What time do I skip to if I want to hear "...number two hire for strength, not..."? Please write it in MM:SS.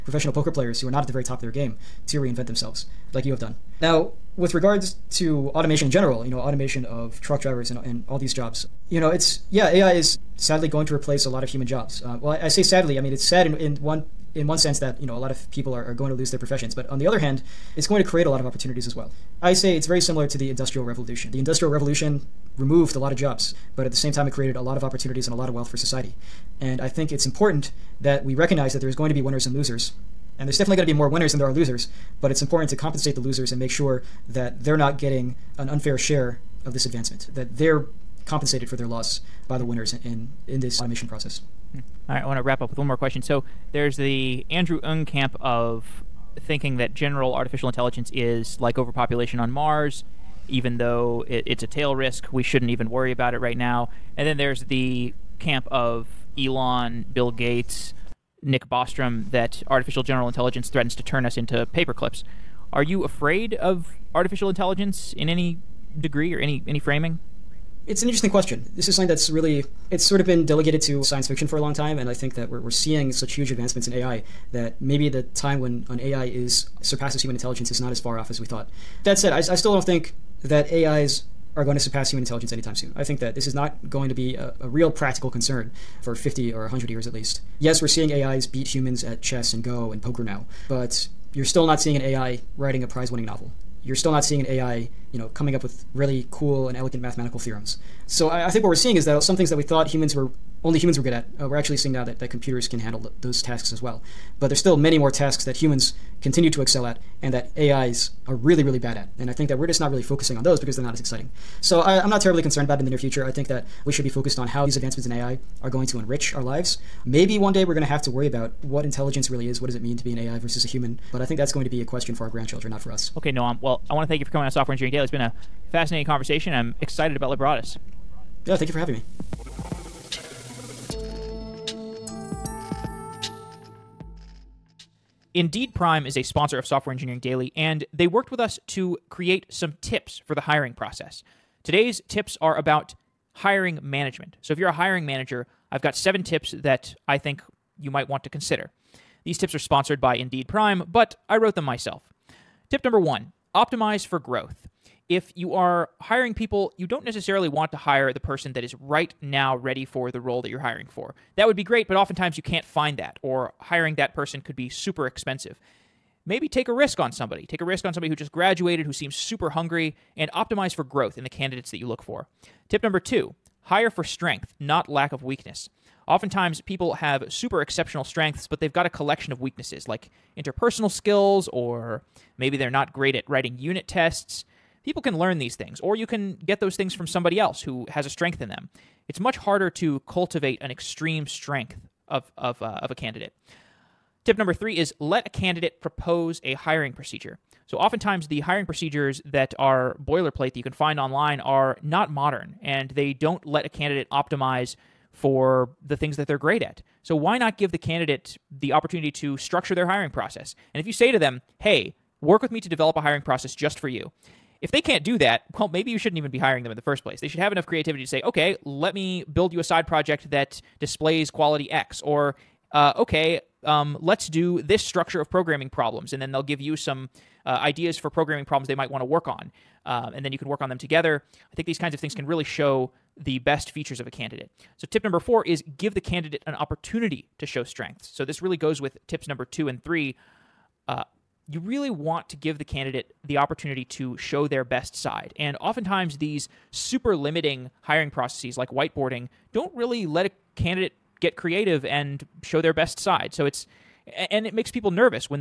02:52.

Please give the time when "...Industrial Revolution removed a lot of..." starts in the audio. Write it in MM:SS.
00:21.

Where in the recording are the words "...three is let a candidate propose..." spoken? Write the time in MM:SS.
03:14.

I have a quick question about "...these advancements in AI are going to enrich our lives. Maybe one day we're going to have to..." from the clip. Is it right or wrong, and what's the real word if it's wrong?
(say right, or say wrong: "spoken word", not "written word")
right.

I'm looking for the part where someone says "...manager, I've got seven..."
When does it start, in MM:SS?
02:25.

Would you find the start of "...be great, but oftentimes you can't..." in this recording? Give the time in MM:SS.
02:41.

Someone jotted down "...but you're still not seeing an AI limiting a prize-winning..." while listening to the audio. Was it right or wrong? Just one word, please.
wrong.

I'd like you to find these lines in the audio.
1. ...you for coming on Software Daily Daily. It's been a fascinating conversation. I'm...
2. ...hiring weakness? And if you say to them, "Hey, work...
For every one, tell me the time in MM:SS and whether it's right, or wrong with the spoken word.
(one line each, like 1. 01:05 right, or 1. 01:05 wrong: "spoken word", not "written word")
1. 02:04 wrong: "Engineering", not "Daily"
2. 03:29 wrong: "process", not "weakness".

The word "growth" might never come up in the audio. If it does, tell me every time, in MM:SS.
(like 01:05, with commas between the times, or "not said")
02:34, 02:50.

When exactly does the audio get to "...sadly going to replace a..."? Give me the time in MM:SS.
00:10.